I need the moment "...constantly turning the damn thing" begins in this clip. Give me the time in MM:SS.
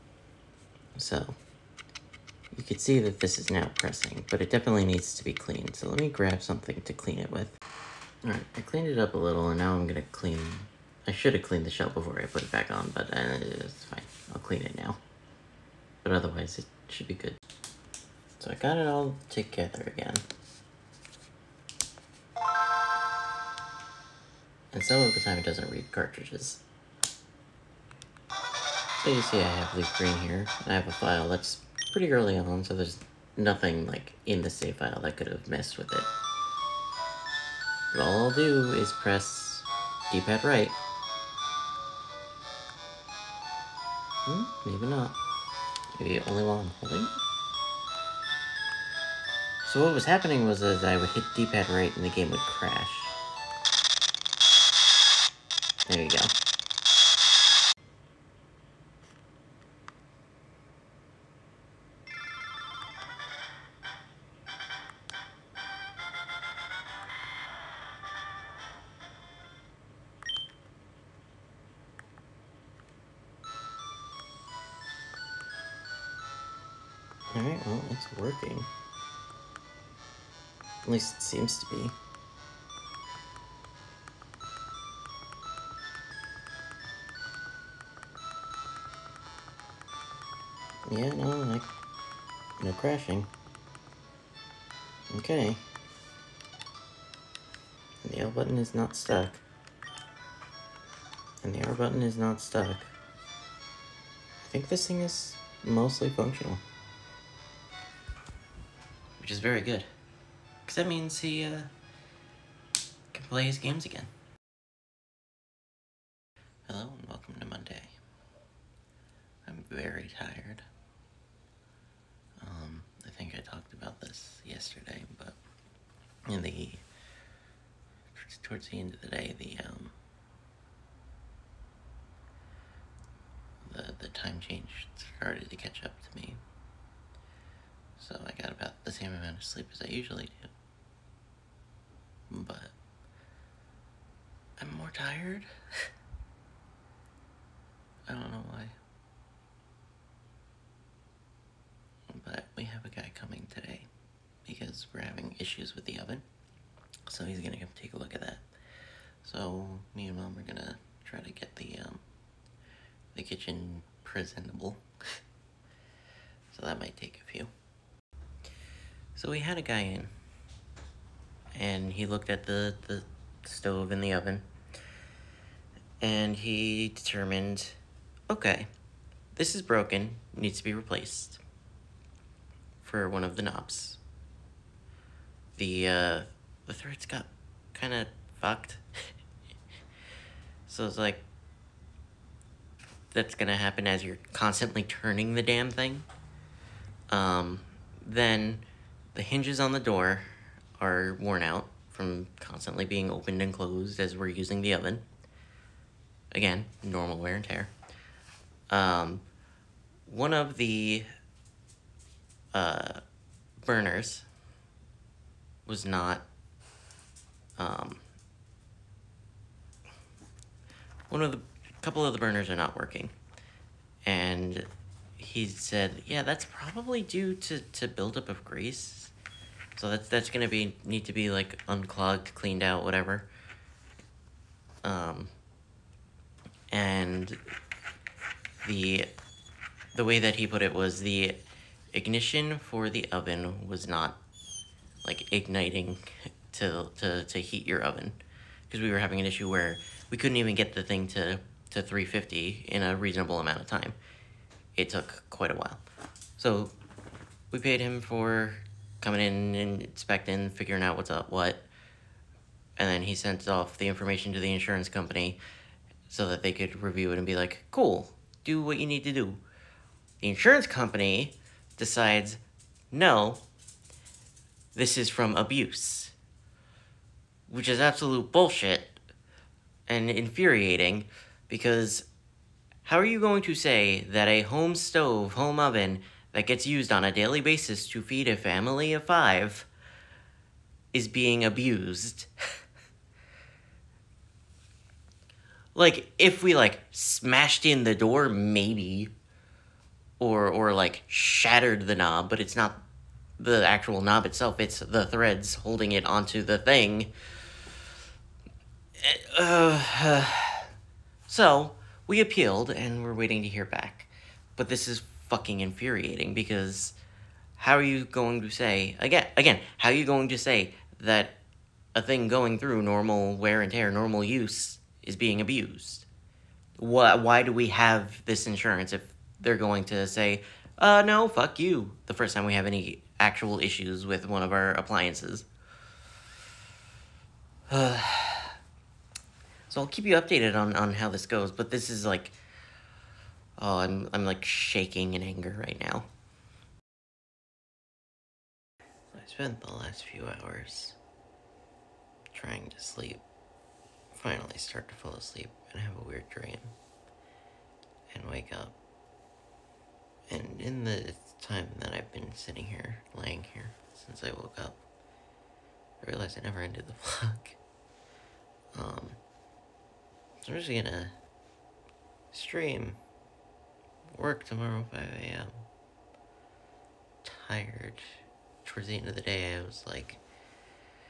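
03:14.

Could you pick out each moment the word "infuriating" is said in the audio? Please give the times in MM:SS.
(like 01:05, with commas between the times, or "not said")
04:40, 05:15.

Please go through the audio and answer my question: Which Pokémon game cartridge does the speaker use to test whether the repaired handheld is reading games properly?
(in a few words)
Leaf Green.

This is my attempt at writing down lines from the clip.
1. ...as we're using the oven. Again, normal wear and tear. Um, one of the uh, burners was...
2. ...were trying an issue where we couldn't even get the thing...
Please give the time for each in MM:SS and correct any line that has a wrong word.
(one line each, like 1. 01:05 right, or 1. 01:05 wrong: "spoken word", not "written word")
1. 03:23 right
2. 04:08 wrong: "having", not "trying".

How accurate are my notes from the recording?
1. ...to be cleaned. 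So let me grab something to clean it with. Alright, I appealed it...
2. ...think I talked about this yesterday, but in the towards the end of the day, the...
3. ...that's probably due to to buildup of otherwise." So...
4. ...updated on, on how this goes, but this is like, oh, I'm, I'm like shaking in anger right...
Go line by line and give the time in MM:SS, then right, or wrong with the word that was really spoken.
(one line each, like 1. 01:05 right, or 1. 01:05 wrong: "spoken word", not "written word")
1. 00:05 wrong: "cleaned", not "appealed"
2. 02:03 right
3. 03:46 wrong: "grease", not "otherwise"
4. 05:40 right.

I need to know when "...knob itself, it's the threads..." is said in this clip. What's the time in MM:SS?
05:04.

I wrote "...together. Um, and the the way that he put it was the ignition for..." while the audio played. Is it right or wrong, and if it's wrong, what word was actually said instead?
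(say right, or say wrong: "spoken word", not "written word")
wrong: "whatever", not "together".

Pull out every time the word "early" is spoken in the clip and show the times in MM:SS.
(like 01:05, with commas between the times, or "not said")
00:32.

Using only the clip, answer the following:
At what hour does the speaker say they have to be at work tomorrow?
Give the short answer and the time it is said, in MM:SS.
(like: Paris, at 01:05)
5 a.m., at 06:14.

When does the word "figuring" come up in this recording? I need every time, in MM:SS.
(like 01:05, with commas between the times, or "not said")
04:20.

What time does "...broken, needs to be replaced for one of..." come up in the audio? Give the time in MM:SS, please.
02:59.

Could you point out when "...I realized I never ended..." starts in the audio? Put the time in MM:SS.
06:06.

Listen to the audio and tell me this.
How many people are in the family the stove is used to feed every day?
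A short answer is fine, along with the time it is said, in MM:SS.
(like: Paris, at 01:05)
5, at 04:49.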